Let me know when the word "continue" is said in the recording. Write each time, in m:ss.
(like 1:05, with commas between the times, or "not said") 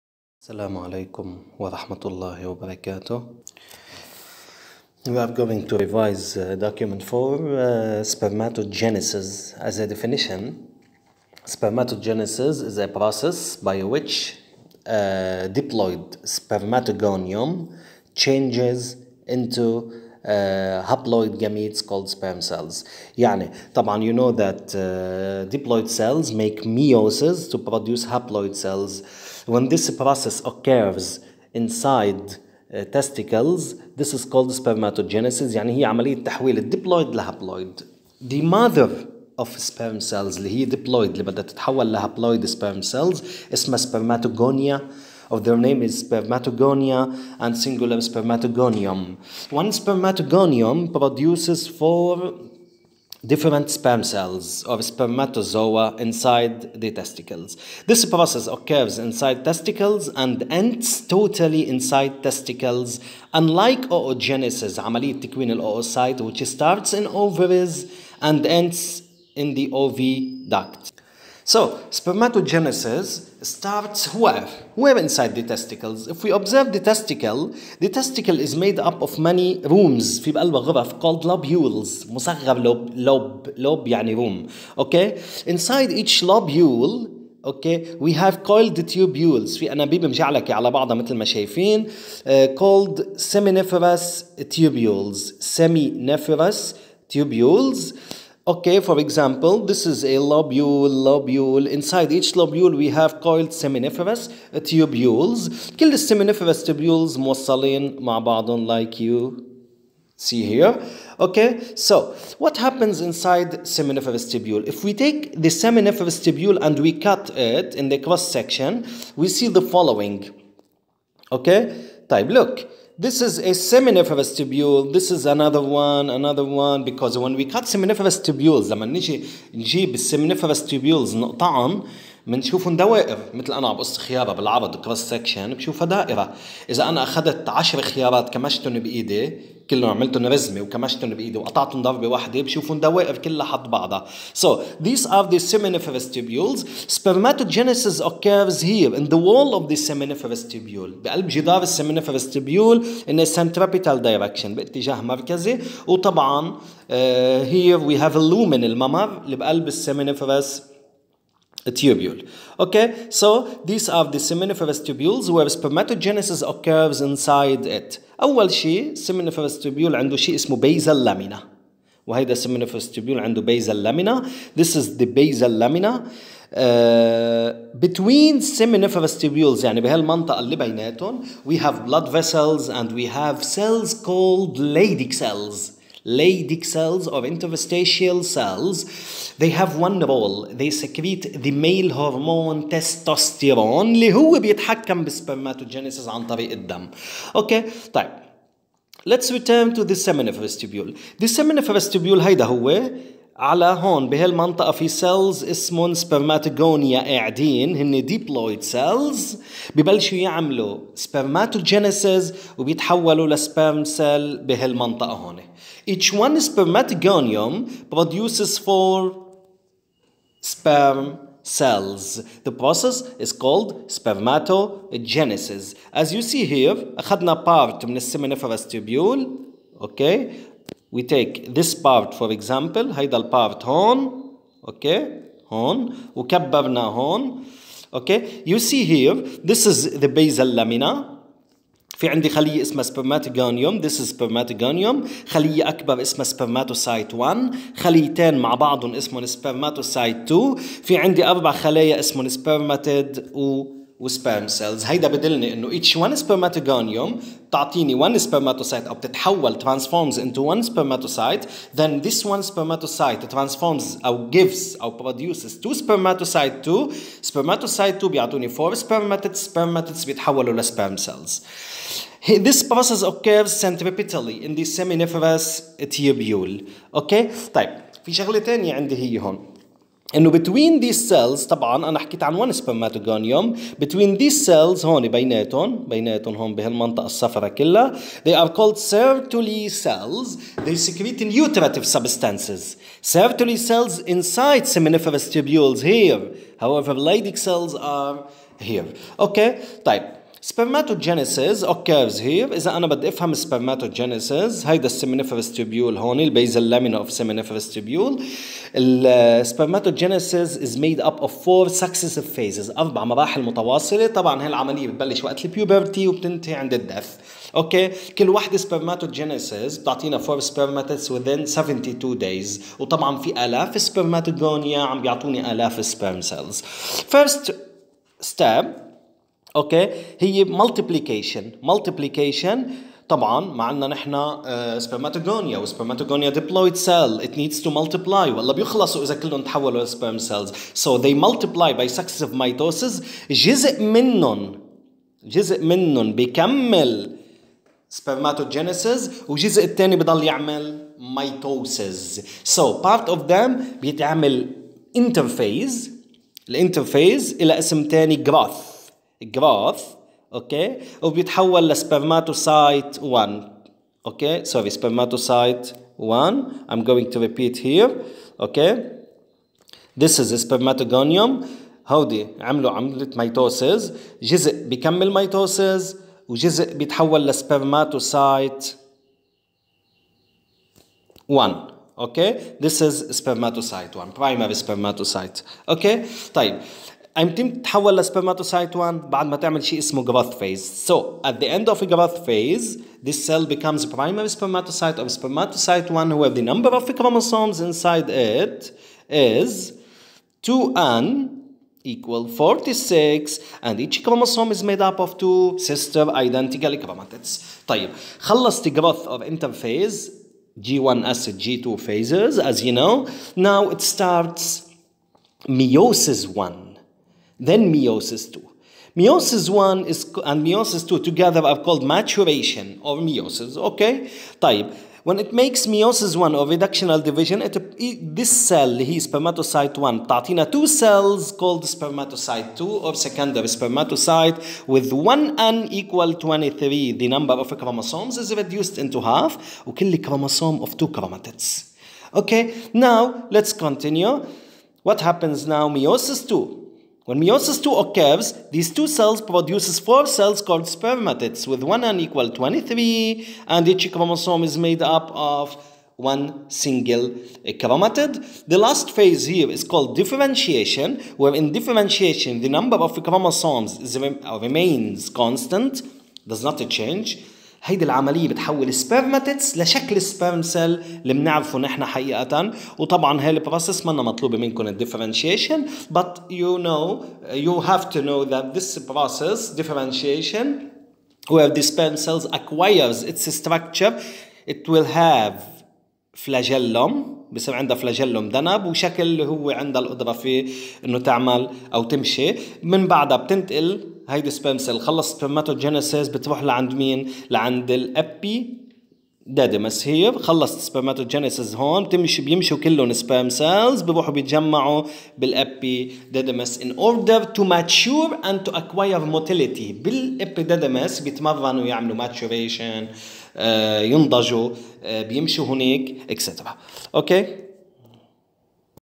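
7:23.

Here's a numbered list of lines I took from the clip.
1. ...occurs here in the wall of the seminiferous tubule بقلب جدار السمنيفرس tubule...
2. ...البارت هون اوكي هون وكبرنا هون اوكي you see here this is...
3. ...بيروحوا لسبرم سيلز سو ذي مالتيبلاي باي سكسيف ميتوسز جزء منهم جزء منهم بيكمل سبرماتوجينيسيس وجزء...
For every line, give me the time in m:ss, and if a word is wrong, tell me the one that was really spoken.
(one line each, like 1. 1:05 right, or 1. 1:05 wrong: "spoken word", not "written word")
1. 2:28 right
2. 3:53 right
3. 5:39 wrong: "تحولوا", not "بيروحوا".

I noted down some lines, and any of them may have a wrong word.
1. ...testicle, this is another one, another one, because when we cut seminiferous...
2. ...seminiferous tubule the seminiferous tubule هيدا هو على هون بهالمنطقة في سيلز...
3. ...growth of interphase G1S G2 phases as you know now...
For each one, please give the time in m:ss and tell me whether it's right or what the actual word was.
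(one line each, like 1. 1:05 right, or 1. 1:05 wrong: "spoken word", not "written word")
1. 2:04 wrong: "tubule", not "testicle"
2. 3:19 right
3. 6:48 right.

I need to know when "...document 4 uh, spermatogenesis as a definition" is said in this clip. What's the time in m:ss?
0:06.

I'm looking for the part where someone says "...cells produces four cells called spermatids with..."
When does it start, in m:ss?
7:28.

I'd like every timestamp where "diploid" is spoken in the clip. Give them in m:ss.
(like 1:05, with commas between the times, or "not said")
0:15, 0:25, 0:40.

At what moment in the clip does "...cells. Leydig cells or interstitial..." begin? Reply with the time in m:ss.
3:05.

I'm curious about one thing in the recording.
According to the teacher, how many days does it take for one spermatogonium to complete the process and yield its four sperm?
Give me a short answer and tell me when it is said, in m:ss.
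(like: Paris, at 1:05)
72 days, at 5:21.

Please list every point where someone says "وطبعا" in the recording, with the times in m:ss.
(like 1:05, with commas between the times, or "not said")
2:35, 5:22, 7:52.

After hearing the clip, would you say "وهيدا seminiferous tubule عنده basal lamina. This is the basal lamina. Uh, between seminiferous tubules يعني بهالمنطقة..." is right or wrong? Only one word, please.
right.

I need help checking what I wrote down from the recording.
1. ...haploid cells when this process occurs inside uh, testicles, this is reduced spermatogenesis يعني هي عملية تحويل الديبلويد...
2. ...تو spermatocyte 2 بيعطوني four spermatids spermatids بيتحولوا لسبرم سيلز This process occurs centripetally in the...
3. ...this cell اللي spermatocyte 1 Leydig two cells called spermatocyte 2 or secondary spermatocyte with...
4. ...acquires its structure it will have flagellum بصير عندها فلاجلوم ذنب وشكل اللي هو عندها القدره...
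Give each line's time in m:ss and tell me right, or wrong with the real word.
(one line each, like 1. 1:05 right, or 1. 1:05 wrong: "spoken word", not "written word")
1. 0:28 wrong: "called", not "reduced"
2. 4:26 right
3. 7:08 wrong: "Tatina", not "Leydig"
4. 8:02 right.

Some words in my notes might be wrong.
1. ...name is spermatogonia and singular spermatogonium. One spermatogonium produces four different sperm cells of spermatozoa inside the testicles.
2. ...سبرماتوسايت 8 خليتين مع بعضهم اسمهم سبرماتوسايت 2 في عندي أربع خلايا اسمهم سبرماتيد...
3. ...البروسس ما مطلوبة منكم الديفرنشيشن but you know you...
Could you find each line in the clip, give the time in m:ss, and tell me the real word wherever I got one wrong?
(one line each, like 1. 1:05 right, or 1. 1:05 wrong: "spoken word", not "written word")
1. 0:45 right
2. 4:06 wrong: "1", not "8"
3. 7:53 right.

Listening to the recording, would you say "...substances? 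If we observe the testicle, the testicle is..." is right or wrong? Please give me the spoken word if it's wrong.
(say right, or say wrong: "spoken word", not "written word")
wrong: "testicles", not "substances".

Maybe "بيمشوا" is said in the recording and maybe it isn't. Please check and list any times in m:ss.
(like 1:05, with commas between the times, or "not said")
8:22, 8:35.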